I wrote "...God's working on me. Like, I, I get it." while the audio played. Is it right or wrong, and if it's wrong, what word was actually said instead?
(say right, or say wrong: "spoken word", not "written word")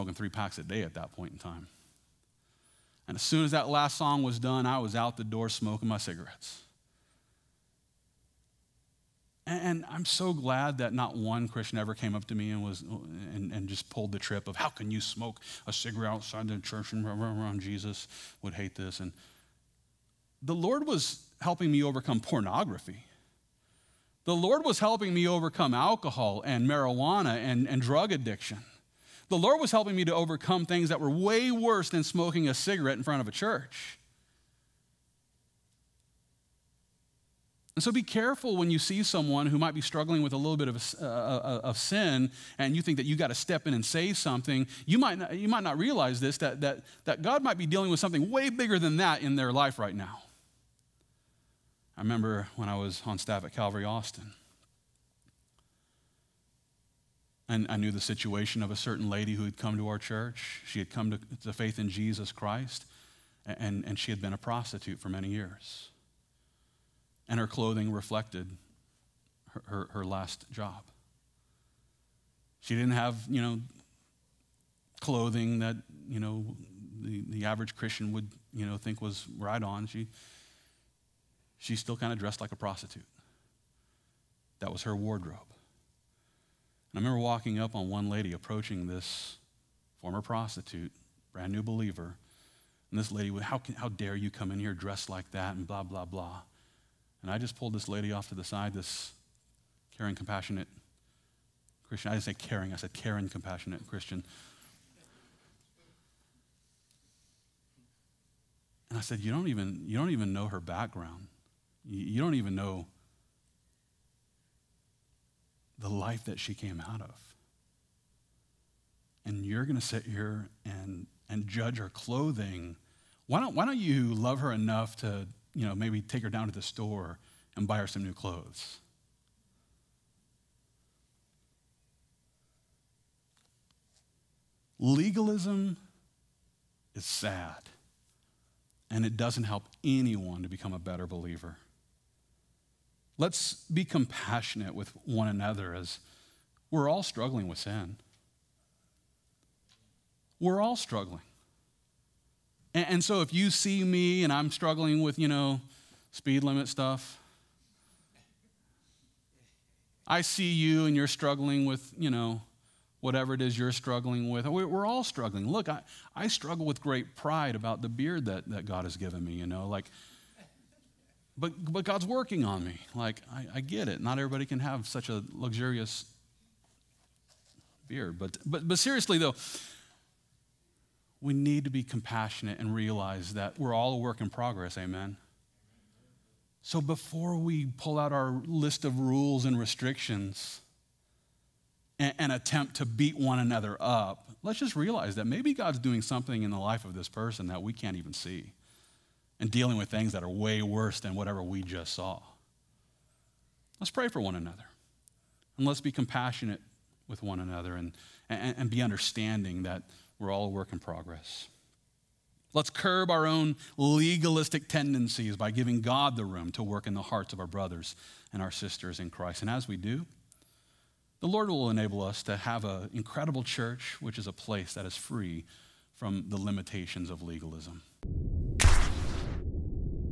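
right.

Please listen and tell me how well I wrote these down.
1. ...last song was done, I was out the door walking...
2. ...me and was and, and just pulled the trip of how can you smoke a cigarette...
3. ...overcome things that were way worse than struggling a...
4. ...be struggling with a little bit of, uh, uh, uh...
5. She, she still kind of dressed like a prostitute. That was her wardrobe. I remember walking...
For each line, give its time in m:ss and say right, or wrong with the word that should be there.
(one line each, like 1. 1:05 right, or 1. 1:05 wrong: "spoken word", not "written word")
1. 0:03 wrong: "smoking", not "walking"
2. 0:12 right
3. 0:30 wrong: "smoking", not "struggling"
4. 0:39 right
5. 1:19 right.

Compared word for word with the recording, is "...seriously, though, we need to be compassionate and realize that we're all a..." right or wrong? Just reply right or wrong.
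right.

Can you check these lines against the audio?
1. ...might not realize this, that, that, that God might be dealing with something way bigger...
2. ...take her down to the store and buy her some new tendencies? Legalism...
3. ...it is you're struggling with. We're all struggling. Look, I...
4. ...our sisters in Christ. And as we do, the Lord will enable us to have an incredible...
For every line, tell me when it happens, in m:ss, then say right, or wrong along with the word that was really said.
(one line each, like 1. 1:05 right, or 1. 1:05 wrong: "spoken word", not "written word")
1. 0:45 right
2. 2:06 wrong: "clothes", not "tendencies"
3. 2:43 right
4. 3:38 right.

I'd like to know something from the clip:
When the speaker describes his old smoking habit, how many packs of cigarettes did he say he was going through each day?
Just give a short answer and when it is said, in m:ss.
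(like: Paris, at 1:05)
3, at 0:00.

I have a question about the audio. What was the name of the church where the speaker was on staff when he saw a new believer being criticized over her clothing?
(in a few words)
Calvary Austin.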